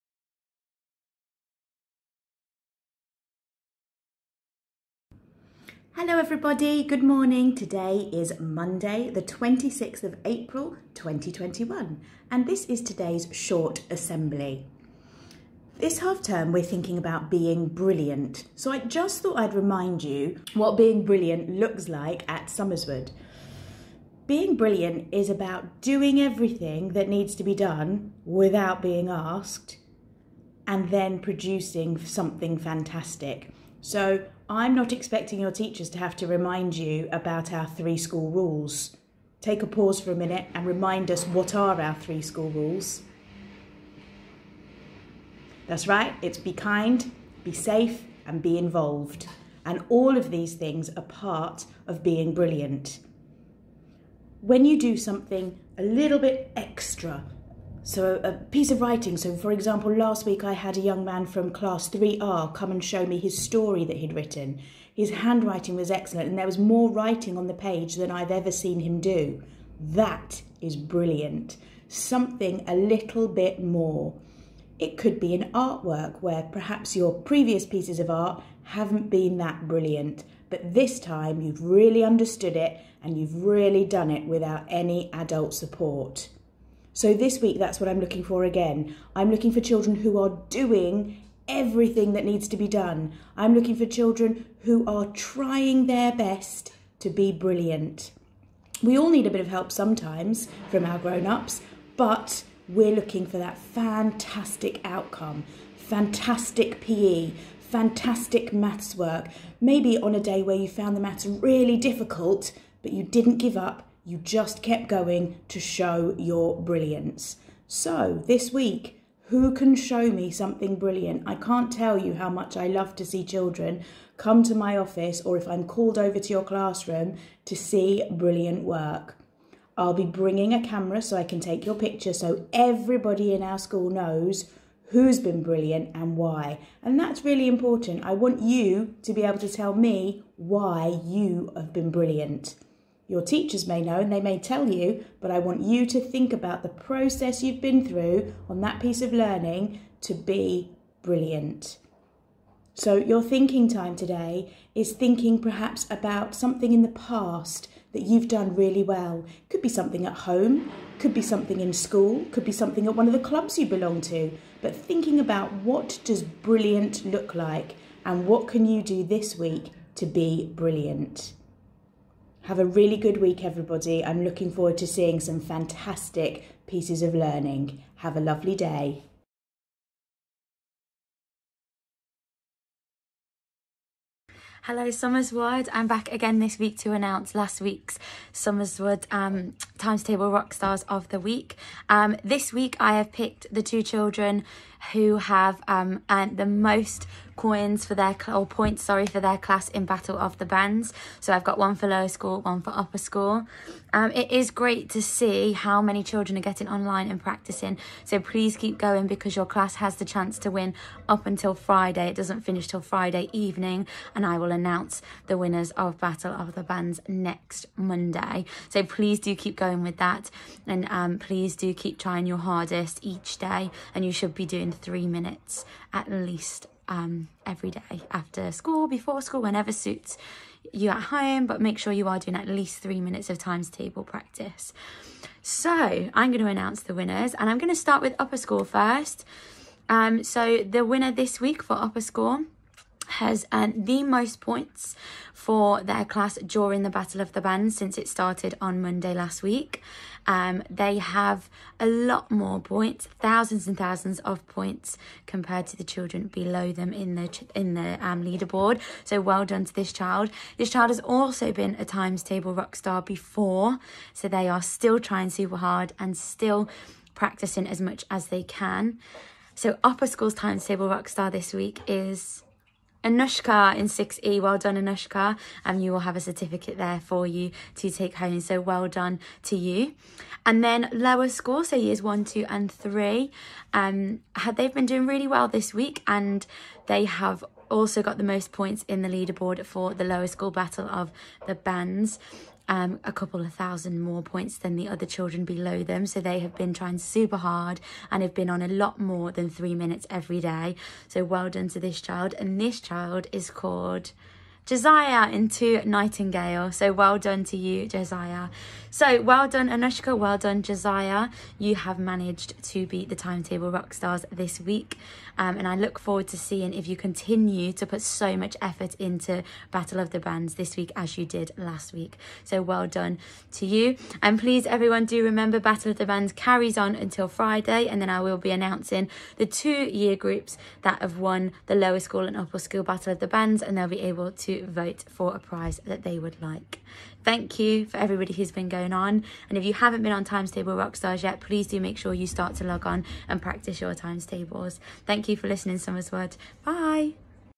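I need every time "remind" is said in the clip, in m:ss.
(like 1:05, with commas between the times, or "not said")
0:19, 0:36, 0:40.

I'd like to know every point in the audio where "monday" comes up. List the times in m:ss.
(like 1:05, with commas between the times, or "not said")
0:08, 3:37, 4:08.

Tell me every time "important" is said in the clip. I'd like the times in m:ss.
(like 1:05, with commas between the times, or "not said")
2:17.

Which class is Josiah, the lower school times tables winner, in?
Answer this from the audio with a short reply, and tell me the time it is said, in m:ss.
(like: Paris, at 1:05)
Nightingale, at 5:05.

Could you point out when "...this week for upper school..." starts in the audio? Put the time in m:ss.
4:01.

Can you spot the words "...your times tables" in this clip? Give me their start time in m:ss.
5:43.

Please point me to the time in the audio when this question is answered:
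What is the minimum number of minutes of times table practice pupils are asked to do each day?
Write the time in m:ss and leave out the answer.
3:44.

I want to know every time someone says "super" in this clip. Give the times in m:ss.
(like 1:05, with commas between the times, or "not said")
4:25, 4:56.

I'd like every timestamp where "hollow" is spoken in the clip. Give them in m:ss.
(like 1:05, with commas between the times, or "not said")
not said.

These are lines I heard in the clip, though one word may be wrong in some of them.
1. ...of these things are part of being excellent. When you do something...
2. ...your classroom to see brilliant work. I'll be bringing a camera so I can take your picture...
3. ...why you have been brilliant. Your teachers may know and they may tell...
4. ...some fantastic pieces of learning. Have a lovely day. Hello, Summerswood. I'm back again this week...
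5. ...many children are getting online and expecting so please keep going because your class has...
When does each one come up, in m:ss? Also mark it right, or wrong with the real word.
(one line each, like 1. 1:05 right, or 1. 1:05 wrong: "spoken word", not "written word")
1. 0:50 wrong: "brilliant", not "excellent"
2. 2:06 right
3. 2:20 right
4. 2:55 right
5. 3:25 wrong: "practicing", not "expecting".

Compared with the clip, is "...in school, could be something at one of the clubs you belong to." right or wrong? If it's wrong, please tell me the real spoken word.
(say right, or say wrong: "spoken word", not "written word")
right.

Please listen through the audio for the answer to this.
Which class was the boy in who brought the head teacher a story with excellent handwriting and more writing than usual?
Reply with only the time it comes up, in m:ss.
1:01.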